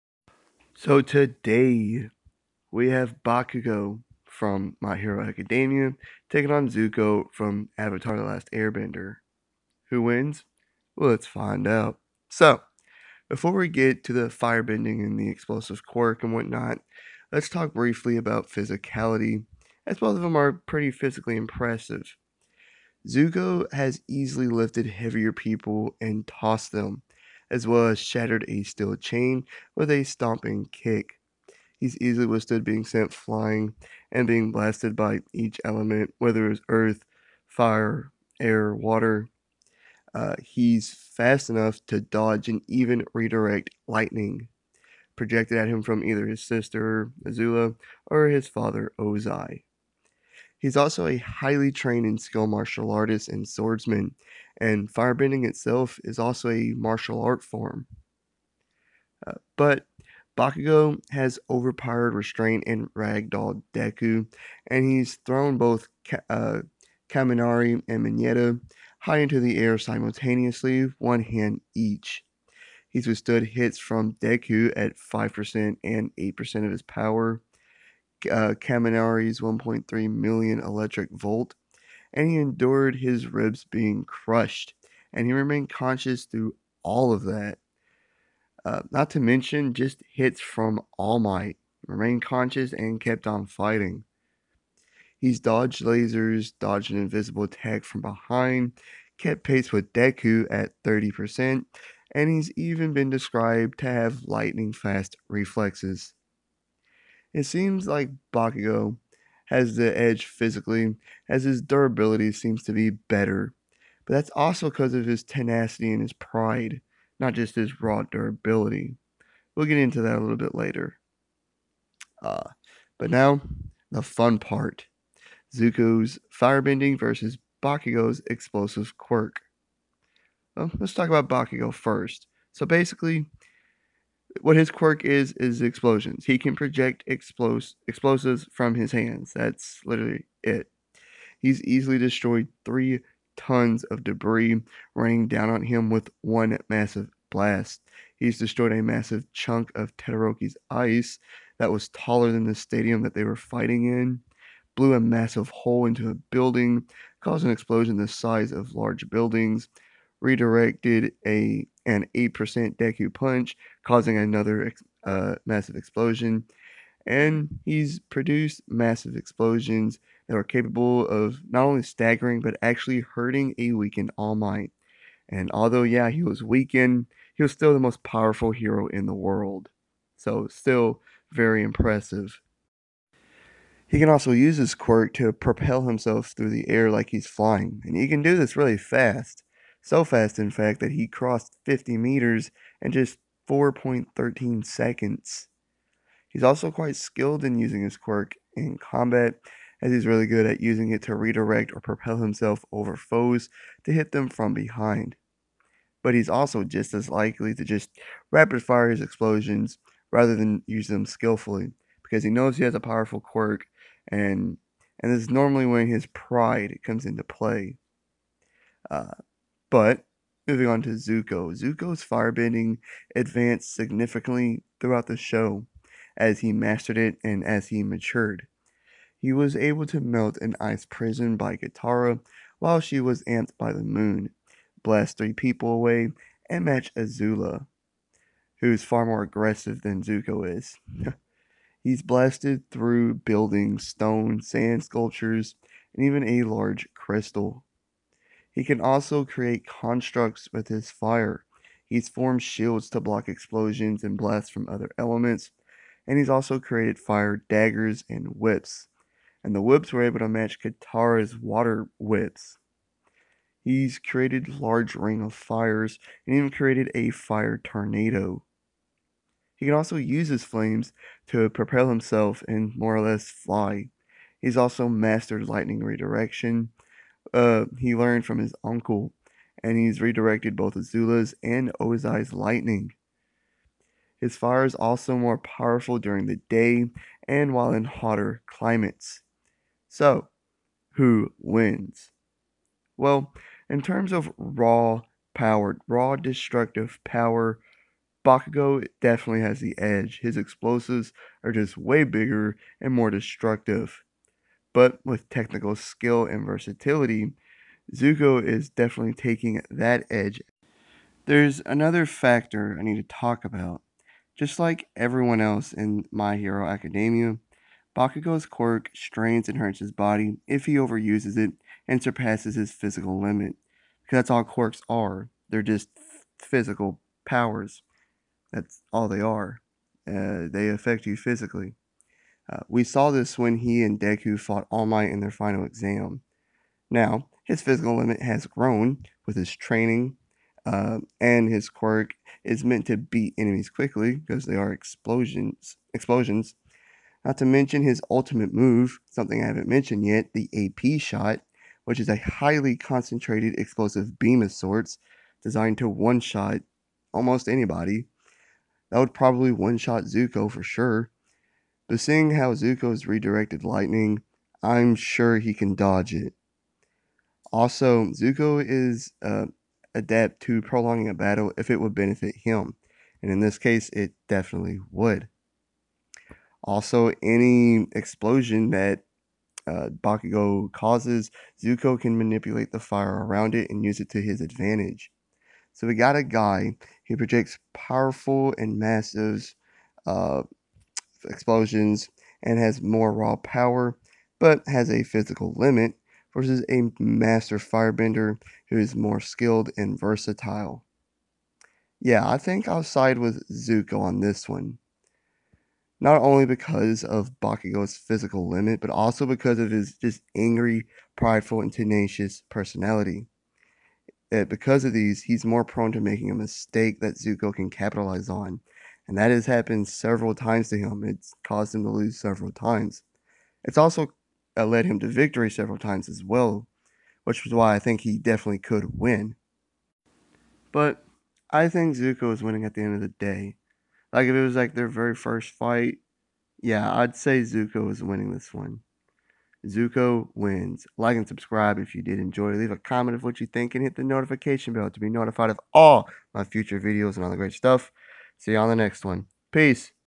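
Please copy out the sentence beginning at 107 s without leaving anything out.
It seems like Bakugo has the edge physically, as his durability seems to be better.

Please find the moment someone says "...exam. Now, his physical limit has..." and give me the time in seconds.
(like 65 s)
335 s.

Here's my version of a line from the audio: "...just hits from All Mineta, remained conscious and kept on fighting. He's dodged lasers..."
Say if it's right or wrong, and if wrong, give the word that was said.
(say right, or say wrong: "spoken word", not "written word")
wrong: "Might", not "Mineta".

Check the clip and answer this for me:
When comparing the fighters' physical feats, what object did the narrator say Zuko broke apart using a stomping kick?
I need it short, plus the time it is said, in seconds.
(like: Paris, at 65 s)
steel chain, at 28 s.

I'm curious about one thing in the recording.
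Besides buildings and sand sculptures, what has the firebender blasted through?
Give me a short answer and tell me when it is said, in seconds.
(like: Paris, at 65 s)
a large crystal, at 246 s.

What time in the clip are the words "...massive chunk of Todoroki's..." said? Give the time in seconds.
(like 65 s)
148 s.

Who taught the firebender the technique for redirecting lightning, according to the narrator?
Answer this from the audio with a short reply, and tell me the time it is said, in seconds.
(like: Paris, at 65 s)
his uncle, at 278 s.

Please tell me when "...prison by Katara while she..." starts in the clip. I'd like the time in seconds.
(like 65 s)
230 s.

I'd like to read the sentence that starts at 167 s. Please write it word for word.
And he's produced massive explosions that are capable of not only staggering, but actually hurting a weakened All Might.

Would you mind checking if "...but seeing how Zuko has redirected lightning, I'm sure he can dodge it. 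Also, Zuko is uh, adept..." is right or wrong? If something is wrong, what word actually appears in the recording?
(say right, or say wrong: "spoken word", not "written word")
right.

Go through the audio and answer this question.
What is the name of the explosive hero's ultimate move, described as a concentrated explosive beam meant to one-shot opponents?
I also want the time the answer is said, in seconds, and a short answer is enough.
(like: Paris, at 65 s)
AP shot, at 350 s.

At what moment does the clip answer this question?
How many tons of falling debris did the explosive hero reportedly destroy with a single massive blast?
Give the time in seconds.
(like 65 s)
142 s.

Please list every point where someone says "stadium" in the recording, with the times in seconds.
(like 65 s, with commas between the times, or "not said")
152 s.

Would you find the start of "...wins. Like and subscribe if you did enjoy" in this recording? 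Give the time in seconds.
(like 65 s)
440 s.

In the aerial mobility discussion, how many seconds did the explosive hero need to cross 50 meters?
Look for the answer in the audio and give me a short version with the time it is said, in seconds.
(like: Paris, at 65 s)
4.13, at 193 s.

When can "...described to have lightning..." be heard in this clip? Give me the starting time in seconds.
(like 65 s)
103 s.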